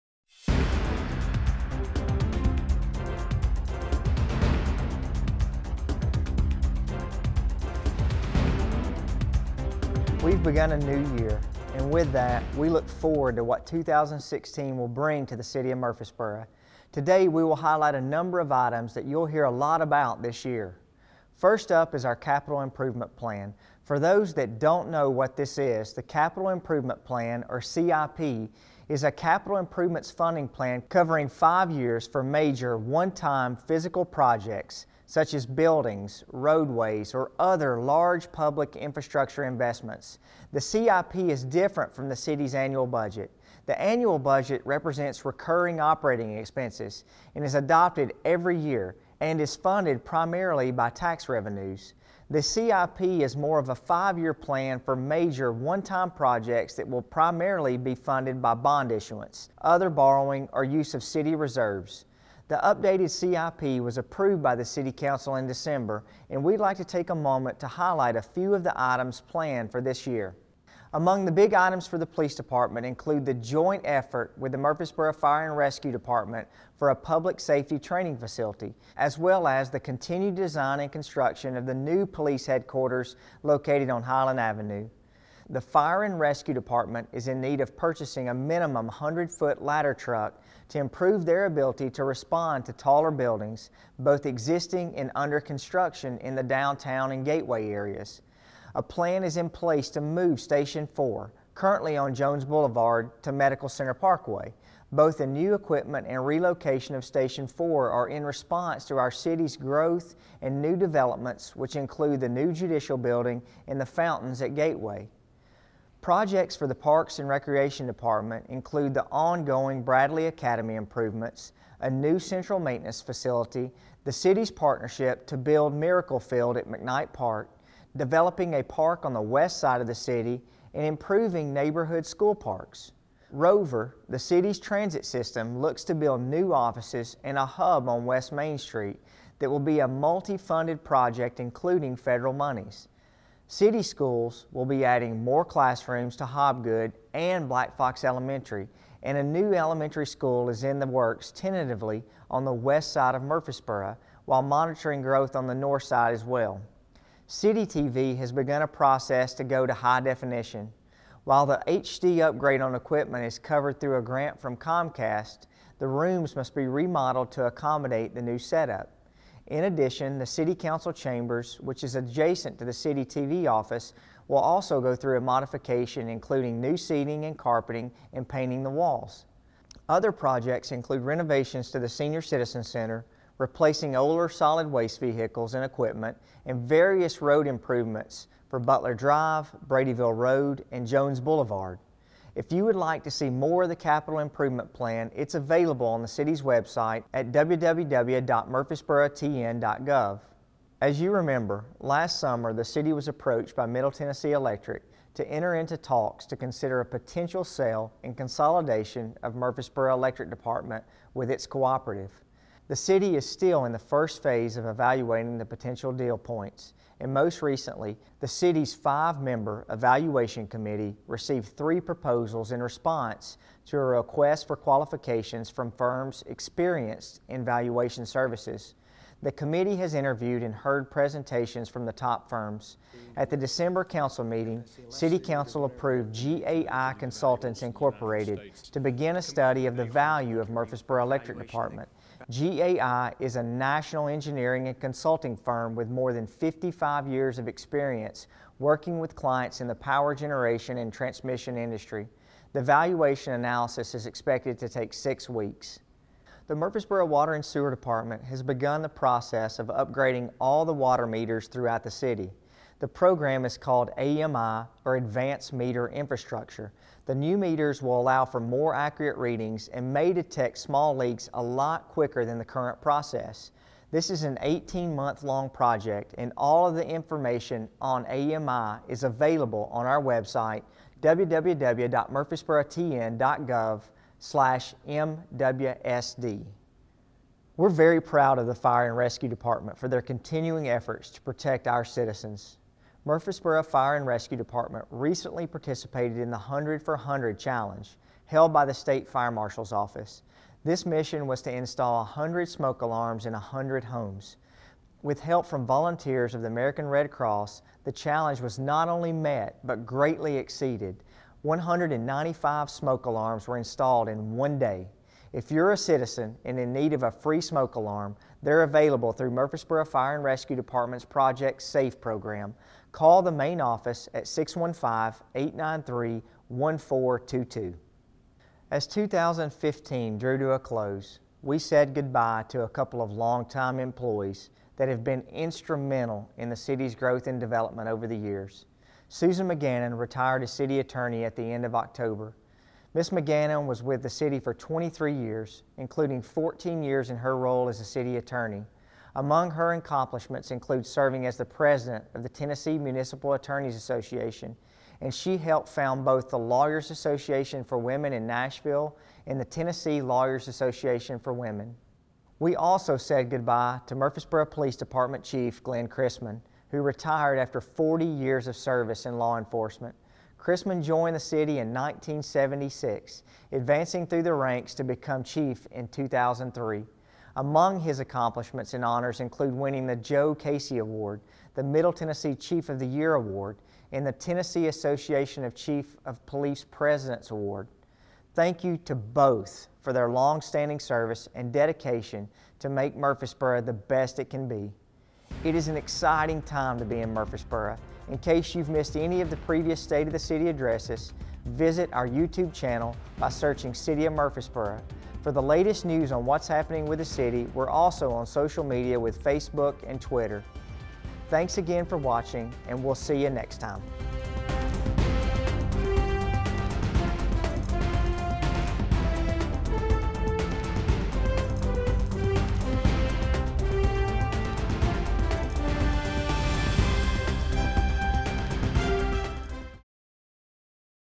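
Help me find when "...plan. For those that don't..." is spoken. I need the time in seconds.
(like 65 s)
23 s.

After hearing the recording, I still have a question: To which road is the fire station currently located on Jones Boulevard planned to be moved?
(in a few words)
Medical Center Parkway.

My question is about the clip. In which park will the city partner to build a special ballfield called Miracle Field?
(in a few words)
McKnight Park.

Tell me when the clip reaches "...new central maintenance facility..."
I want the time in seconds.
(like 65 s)
121 s.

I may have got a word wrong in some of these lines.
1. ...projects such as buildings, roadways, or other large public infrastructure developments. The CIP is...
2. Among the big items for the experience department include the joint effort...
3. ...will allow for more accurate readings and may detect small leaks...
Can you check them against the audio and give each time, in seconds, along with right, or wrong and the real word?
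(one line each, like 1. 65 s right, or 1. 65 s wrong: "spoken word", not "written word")
1. 34 s wrong: "investments", not "developments"
2. 70 s wrong: "police", not "experience"
3. 267 s right.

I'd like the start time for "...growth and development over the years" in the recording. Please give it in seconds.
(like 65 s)
336 s.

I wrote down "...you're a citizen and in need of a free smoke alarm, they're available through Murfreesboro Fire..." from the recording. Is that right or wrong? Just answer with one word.
right.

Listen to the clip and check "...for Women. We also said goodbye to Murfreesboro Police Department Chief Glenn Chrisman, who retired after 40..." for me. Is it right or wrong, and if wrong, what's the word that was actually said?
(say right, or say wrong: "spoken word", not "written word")
right.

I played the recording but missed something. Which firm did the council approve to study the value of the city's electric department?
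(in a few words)
GAI Consultants Incorporated.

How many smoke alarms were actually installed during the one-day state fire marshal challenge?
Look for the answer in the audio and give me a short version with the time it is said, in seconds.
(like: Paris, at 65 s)
195, at 311 s.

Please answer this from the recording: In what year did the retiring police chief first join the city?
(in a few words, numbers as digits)
1976.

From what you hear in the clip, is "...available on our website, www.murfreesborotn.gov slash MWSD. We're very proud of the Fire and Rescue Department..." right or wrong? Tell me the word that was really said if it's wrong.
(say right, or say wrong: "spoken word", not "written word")
right.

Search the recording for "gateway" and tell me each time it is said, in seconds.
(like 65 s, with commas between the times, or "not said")
97 s, 114 s.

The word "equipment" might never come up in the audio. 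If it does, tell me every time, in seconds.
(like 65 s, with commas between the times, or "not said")
105 s, 162 s, 185 s.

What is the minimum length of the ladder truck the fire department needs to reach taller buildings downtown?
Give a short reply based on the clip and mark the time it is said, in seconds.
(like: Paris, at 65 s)
100-foot, at 88 s.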